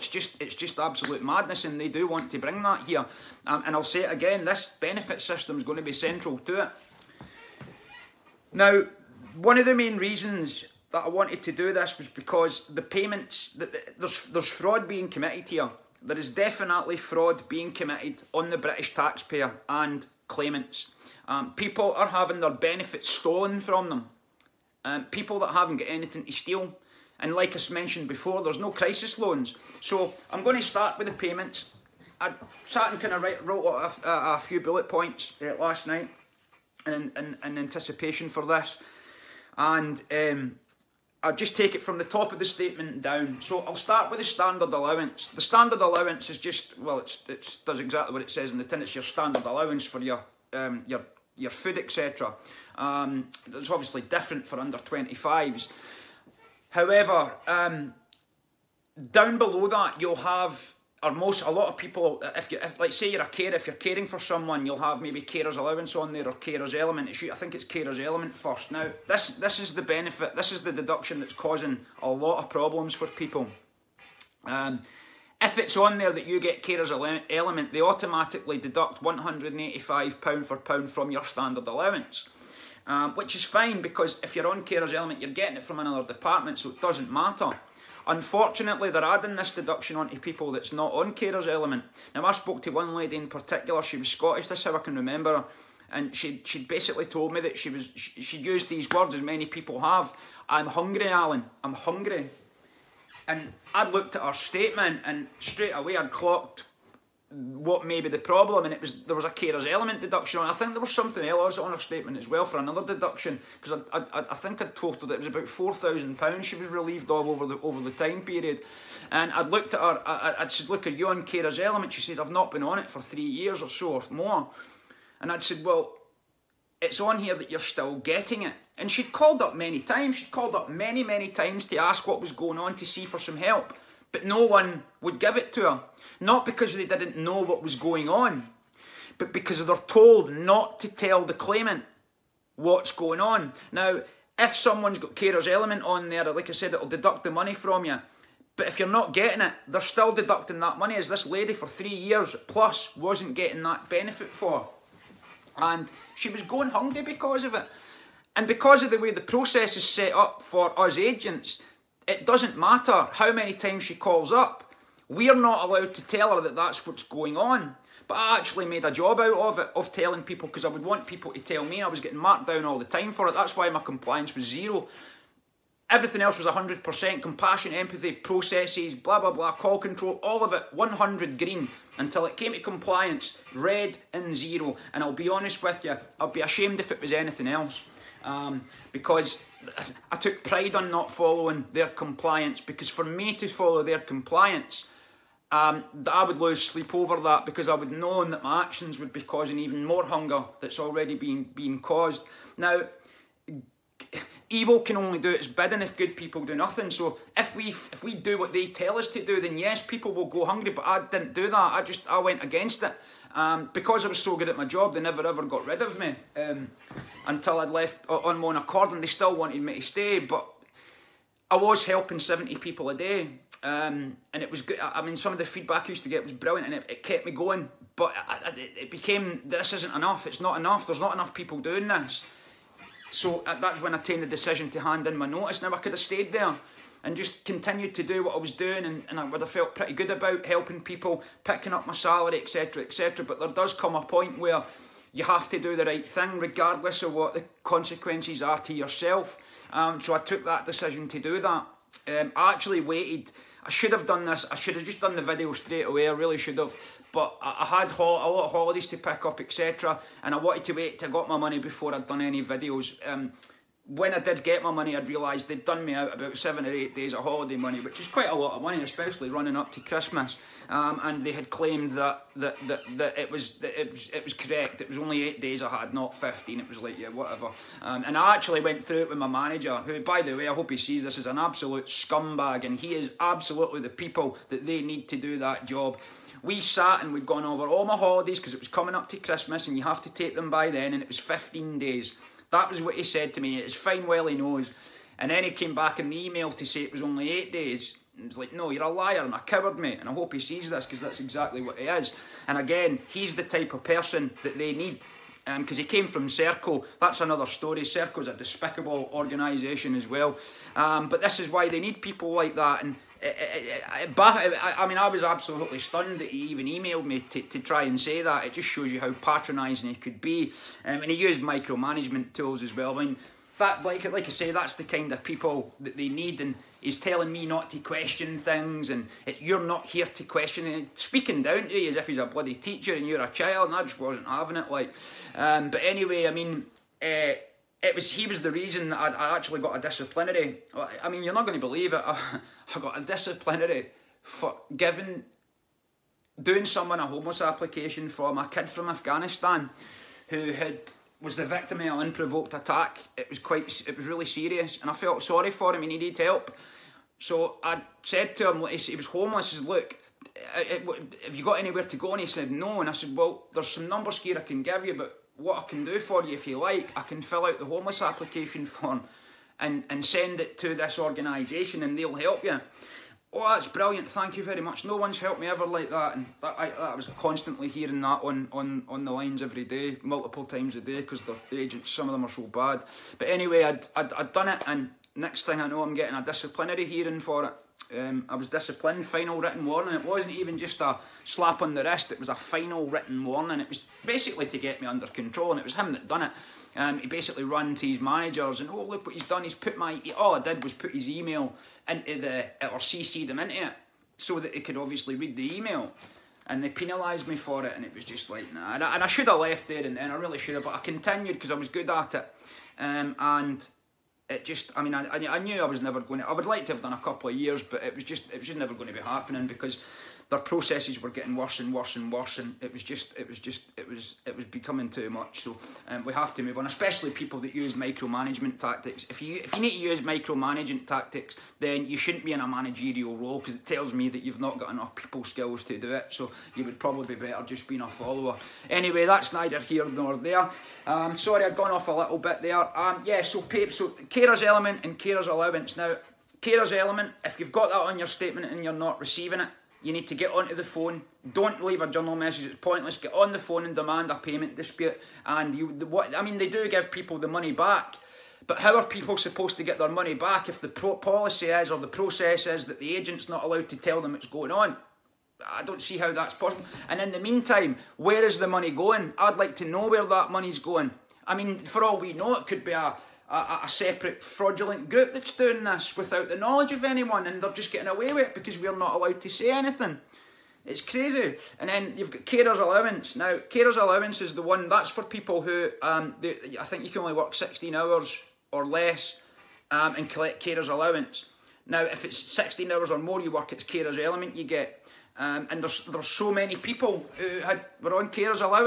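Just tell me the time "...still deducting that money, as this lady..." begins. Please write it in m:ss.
2:29.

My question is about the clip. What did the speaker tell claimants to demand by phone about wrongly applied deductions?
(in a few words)
A payment dispute.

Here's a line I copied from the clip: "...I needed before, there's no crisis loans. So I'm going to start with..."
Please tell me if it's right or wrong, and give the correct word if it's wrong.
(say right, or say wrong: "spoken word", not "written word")
wrong: "mentioned", not "needed".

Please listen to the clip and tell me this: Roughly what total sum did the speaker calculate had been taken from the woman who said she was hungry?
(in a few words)
4,000 pounds.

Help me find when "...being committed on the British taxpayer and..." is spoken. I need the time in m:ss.
0:17.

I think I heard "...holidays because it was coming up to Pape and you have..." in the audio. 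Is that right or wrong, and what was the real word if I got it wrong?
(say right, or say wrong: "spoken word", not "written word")
wrong: "Christmas", not "Pape".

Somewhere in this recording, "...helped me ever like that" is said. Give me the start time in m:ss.
6:15.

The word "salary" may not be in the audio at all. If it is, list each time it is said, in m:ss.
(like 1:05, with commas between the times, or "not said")
4:01.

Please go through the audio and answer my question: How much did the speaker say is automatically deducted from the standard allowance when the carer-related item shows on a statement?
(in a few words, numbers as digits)
185 pounds.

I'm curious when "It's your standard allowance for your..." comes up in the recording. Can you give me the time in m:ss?
0:48.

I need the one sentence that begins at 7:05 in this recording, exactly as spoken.
So um, we have to move on, especially people that use micromanagement tactics.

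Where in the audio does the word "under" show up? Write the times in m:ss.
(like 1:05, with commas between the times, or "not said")
0:54, 6:34.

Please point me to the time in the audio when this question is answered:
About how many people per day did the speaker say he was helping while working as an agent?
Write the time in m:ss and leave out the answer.
3:42.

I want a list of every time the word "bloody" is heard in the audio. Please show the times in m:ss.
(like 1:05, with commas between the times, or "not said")
5:32.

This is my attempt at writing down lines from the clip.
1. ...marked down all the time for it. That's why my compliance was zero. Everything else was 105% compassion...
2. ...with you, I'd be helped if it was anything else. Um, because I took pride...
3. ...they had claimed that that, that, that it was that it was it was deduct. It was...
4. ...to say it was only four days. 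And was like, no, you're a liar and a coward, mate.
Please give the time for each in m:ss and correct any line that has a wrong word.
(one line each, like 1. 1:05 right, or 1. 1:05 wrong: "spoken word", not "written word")
1. 2:52 wrong: "100", not "105"
2. 3:05 wrong: "ashamed", not "helped"
3. 4:31 wrong: "correct", not "deduct"
4. 4:56 wrong: "eight", not "four".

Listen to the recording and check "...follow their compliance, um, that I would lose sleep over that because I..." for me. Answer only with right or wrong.
right.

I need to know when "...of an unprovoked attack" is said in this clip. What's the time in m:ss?
5:51.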